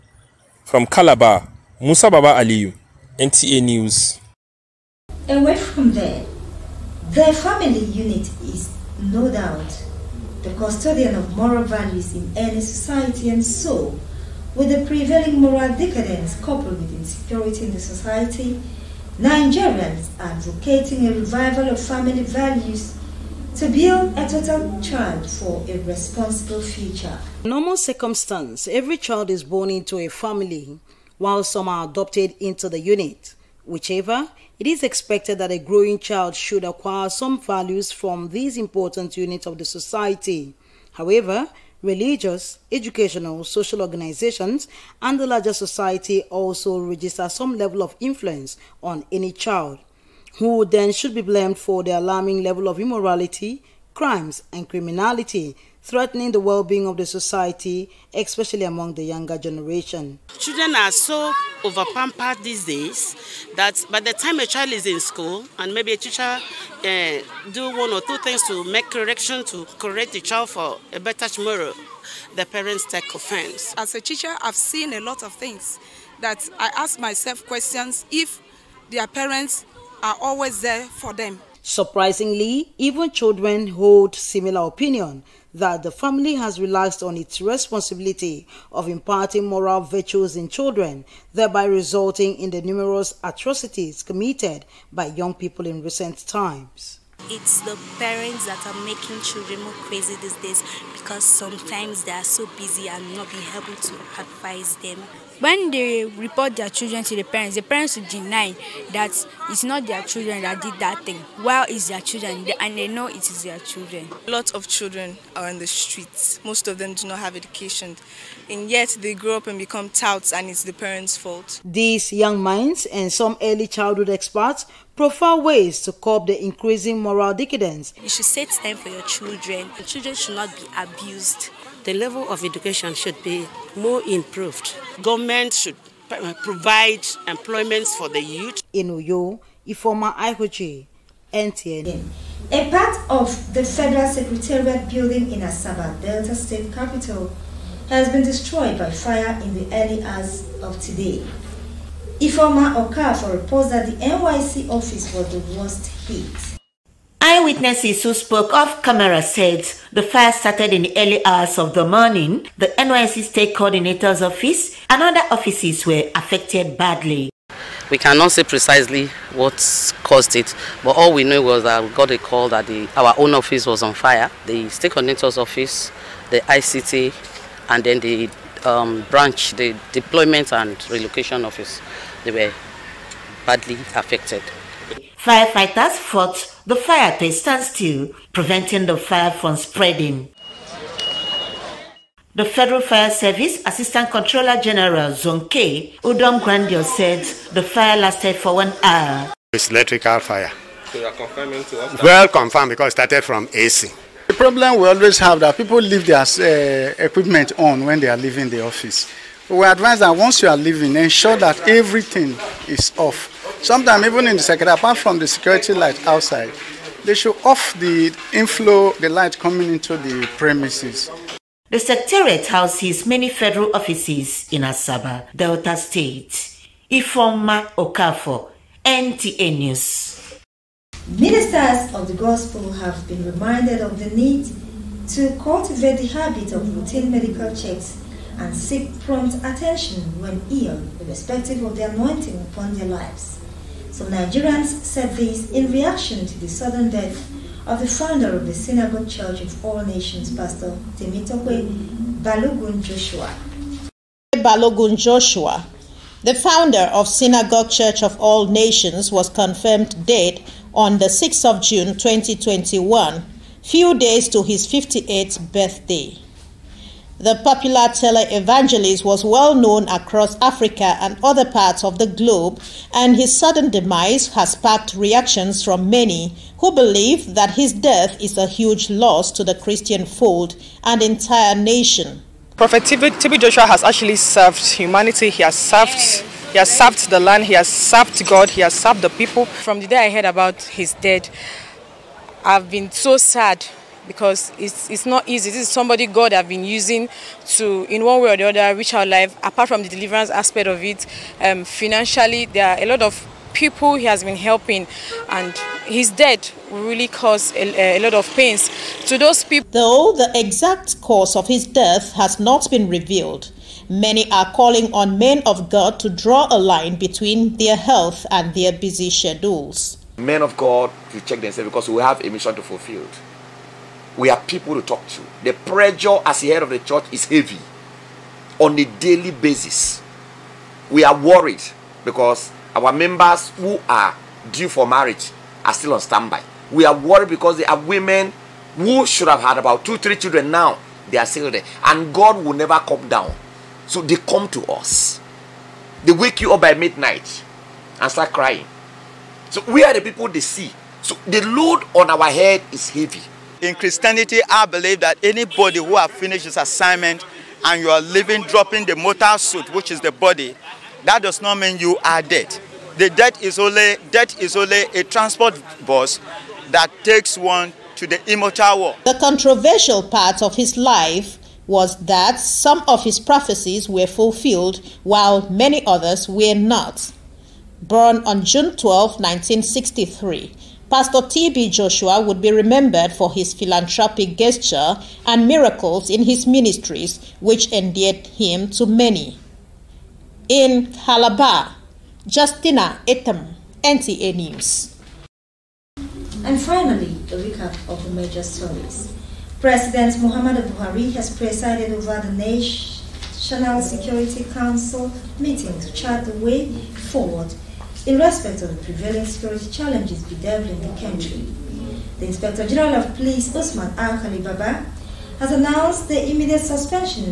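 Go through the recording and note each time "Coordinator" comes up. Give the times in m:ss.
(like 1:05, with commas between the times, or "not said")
2:43, 2:54.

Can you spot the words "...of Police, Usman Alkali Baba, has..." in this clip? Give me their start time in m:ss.
6:52.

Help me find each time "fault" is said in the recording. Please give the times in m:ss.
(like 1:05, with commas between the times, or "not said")
2:01.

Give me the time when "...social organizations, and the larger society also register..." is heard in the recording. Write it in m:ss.
0:43.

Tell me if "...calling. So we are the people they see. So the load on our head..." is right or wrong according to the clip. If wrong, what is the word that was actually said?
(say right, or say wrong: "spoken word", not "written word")
wrong: "crying", not "calling".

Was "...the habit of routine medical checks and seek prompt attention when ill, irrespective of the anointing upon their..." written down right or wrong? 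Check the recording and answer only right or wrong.
right.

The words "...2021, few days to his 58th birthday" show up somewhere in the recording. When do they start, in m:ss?
4:21.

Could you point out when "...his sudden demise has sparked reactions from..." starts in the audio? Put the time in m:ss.
4:33.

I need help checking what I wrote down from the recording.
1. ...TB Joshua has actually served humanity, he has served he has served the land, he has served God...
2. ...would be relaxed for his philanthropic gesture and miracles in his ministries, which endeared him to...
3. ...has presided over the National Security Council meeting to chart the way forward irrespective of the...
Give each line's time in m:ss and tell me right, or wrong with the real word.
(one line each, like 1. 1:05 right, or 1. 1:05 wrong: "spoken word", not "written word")
1. 4:42 right
2. 6:22 wrong: "remembered", not "relaxed"
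3. 6:41 right.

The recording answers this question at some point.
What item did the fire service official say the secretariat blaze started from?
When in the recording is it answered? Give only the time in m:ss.
3:23.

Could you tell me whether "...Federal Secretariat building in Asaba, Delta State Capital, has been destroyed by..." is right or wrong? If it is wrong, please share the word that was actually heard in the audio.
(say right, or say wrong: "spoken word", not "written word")
right.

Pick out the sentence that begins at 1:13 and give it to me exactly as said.
As a teacher, I've seen a lot of things that I ask myself questions if their parents are always there for them.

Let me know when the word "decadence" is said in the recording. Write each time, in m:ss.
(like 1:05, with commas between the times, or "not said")
0:15, 2:07.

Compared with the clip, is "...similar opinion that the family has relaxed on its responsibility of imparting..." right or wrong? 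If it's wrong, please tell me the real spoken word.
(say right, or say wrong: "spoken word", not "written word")
right.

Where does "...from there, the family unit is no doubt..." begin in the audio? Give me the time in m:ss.
0:05.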